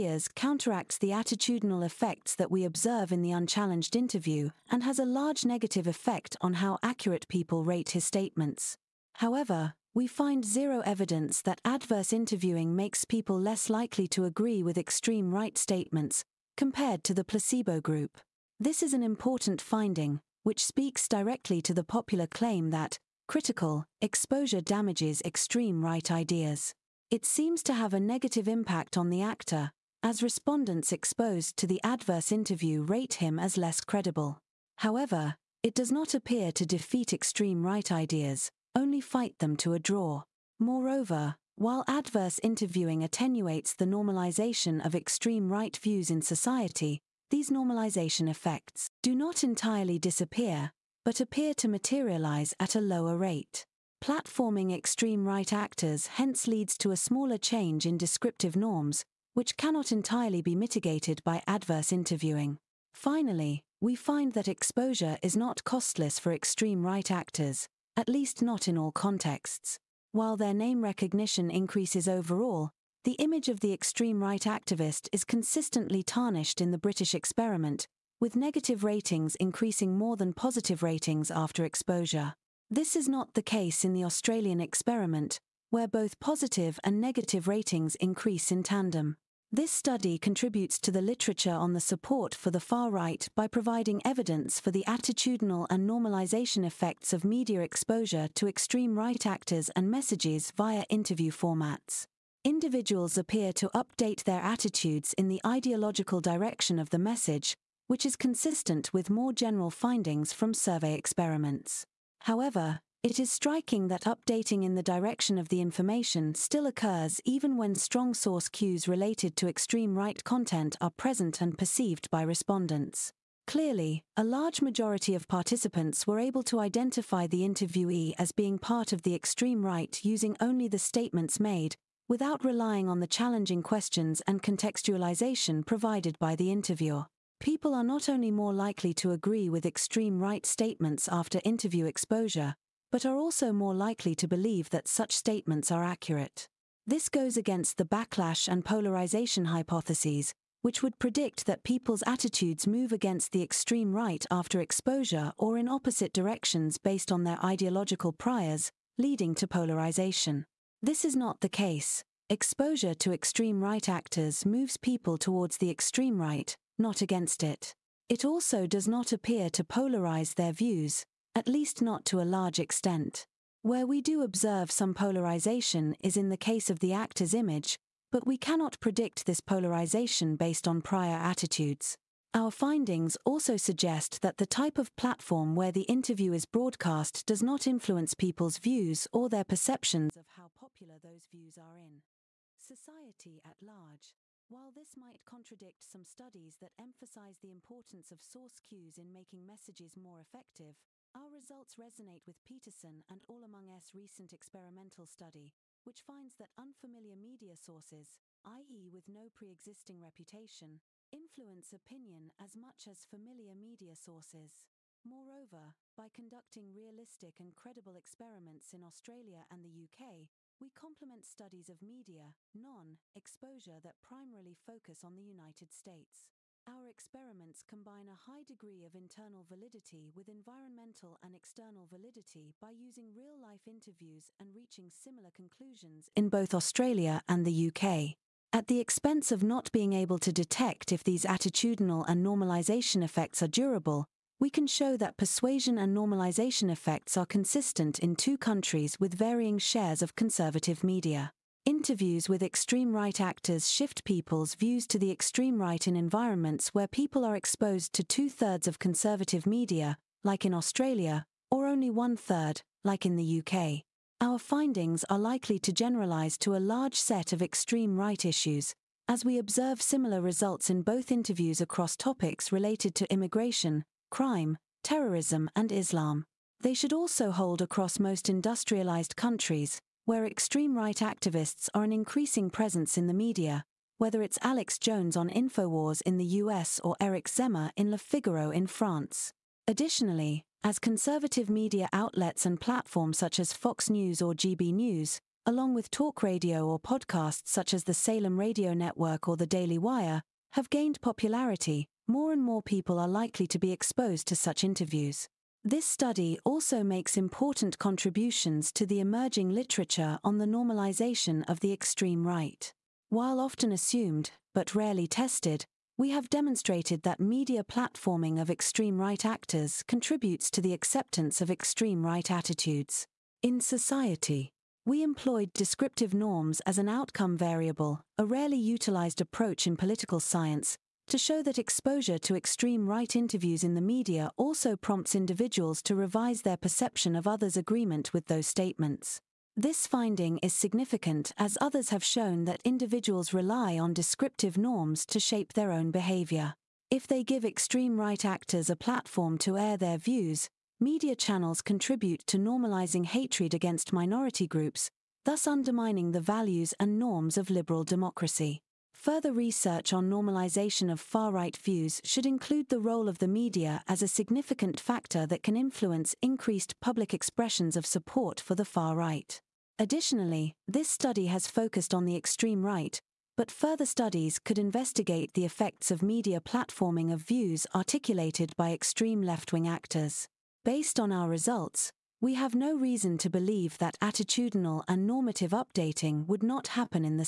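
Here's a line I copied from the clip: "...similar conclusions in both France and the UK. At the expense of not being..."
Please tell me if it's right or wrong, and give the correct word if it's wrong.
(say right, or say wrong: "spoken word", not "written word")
wrong: "Australia", not "France".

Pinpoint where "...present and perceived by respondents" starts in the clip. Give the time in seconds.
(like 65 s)
120 s.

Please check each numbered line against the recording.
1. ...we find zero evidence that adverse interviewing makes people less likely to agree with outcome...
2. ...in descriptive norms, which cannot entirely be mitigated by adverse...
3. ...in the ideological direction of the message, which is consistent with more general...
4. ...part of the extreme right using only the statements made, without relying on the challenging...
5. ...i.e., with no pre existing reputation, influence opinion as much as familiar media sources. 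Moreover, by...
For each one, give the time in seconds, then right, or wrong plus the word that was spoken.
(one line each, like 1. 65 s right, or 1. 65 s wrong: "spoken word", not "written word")
1. 9 s wrong: "extreme", not "outcome"
2. 57 s right
3. 105 s right
4. 128 s right
5. 208 s right.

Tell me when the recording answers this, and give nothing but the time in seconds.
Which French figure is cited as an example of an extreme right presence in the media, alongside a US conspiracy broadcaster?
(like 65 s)
286 s.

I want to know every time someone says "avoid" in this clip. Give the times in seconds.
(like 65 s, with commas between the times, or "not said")
not said.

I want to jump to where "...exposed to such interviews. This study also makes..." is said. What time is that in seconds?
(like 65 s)
303 s.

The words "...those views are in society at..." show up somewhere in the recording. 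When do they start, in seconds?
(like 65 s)
190 s.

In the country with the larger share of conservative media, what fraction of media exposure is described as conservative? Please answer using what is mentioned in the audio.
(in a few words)
Two thirds.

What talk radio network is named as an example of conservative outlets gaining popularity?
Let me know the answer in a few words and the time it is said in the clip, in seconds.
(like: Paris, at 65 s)
Salem Radio Network, at 297 s.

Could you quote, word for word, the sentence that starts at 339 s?
This finding is significant as others have shown that individuals rely on descriptive norms to shape their own behavior.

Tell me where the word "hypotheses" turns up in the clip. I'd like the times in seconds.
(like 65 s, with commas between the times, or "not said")
149 s.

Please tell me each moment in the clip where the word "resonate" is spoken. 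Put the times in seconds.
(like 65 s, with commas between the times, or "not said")
201 s.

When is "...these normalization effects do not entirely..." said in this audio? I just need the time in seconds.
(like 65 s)
47 s.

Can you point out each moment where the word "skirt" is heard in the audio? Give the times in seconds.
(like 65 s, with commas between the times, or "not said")
not said.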